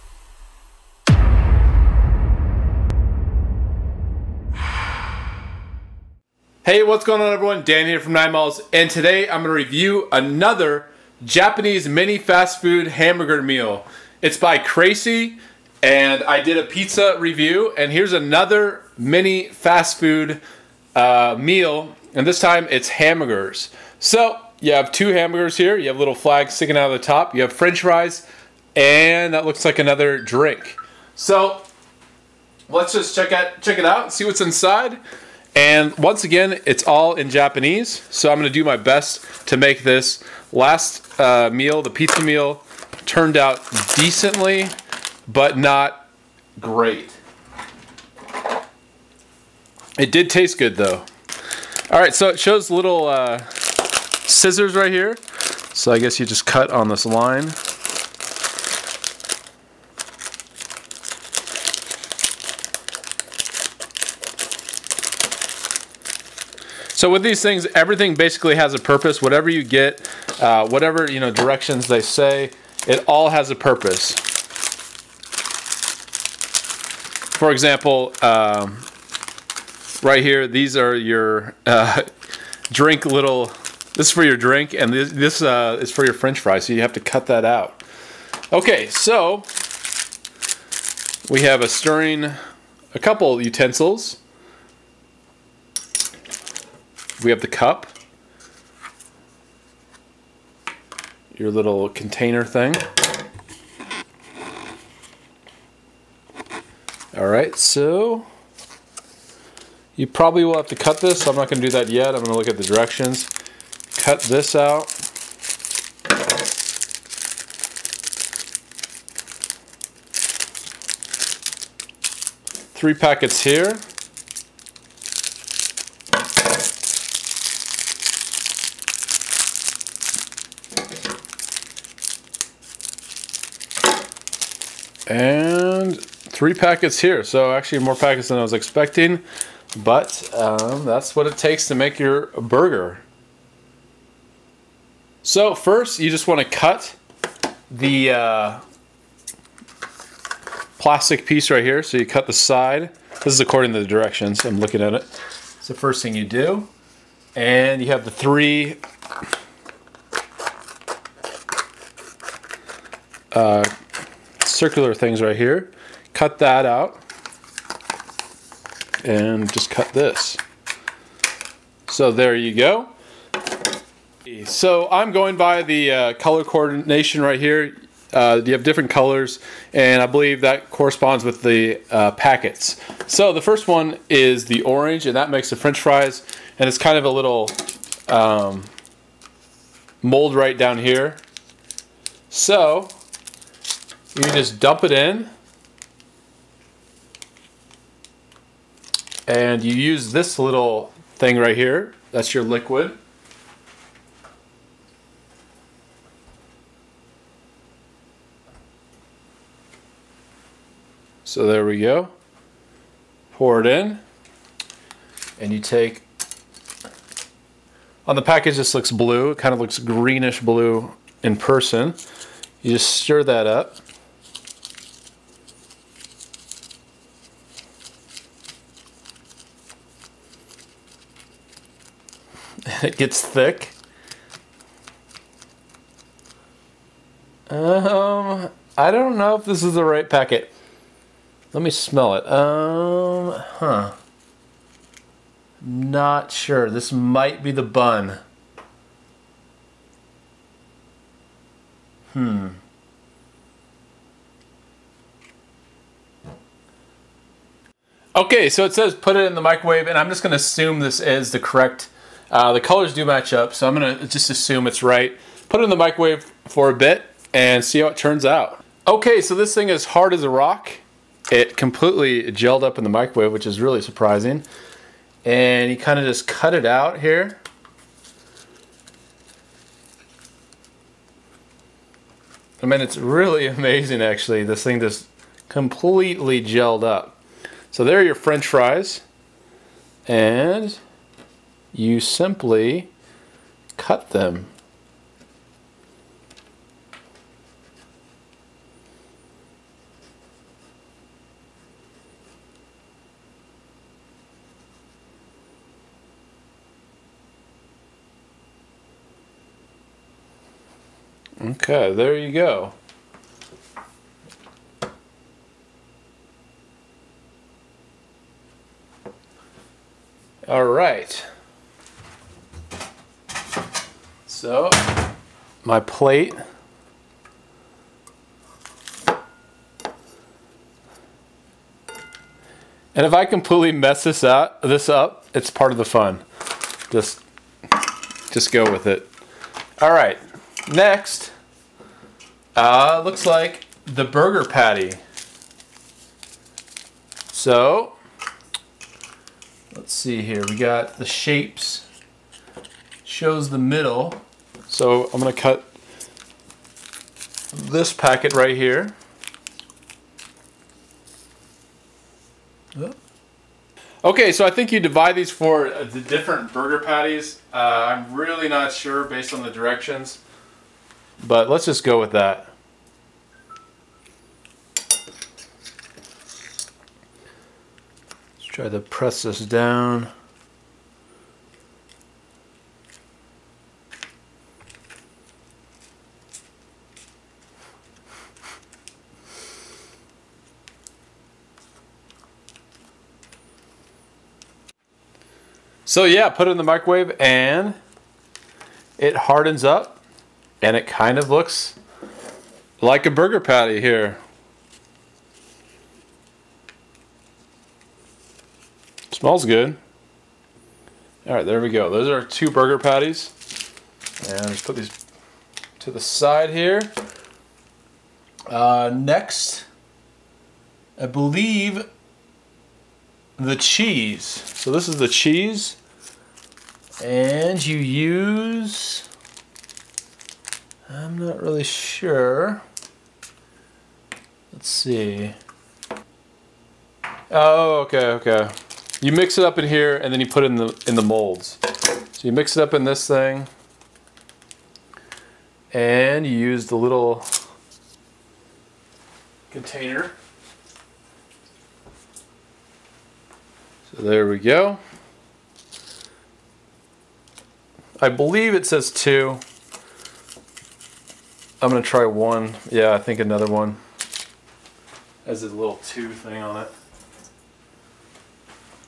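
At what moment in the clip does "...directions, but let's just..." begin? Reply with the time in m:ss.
6:09.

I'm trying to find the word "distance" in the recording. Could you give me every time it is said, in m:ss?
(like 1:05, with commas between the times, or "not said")
not said.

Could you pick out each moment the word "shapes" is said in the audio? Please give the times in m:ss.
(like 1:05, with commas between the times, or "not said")
5:51.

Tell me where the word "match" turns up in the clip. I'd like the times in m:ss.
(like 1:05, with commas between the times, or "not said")
4:23.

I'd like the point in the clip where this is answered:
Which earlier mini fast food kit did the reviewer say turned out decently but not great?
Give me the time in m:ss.
0:41.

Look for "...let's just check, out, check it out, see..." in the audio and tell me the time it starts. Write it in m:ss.
0:32.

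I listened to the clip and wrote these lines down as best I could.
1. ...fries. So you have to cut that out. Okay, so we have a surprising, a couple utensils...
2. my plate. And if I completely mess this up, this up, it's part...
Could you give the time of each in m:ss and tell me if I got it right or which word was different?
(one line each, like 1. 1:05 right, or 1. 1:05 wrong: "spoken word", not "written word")
1. 1:26 wrong: "stirring", not "surprising"
2. 5:25 right.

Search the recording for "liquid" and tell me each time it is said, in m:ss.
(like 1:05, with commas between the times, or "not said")
3:22.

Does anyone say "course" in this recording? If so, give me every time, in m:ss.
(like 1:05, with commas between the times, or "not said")
not said.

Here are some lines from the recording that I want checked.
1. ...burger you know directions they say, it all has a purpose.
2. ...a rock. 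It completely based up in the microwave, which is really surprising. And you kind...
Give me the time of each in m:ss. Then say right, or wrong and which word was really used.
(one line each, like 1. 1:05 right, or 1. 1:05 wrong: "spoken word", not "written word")
1. 1:10 wrong: "whatever", not "burger"
2. 4:30 wrong: "gelled", not "based".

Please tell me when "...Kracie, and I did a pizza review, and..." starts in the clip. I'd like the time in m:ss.
0:14.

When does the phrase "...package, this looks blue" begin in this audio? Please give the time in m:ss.
3:38.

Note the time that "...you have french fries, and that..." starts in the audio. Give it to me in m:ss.
0:27.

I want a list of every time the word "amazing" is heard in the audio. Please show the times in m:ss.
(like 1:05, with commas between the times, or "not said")
4:43.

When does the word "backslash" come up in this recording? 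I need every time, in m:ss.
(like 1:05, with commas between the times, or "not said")
not said.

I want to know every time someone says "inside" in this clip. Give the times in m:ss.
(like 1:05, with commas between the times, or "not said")
0:34.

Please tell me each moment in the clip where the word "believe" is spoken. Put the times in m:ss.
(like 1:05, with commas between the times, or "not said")
3:00, 7:01, 7:38.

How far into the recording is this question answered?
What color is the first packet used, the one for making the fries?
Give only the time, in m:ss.
3:04.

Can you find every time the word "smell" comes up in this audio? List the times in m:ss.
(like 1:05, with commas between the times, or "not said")
4:01, 6:49.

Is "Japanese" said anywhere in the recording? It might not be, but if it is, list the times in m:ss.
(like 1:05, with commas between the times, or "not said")
0:11, 0:37.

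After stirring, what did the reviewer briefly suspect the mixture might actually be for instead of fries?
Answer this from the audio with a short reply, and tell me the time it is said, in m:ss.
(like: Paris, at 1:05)
the bun, at 4:07.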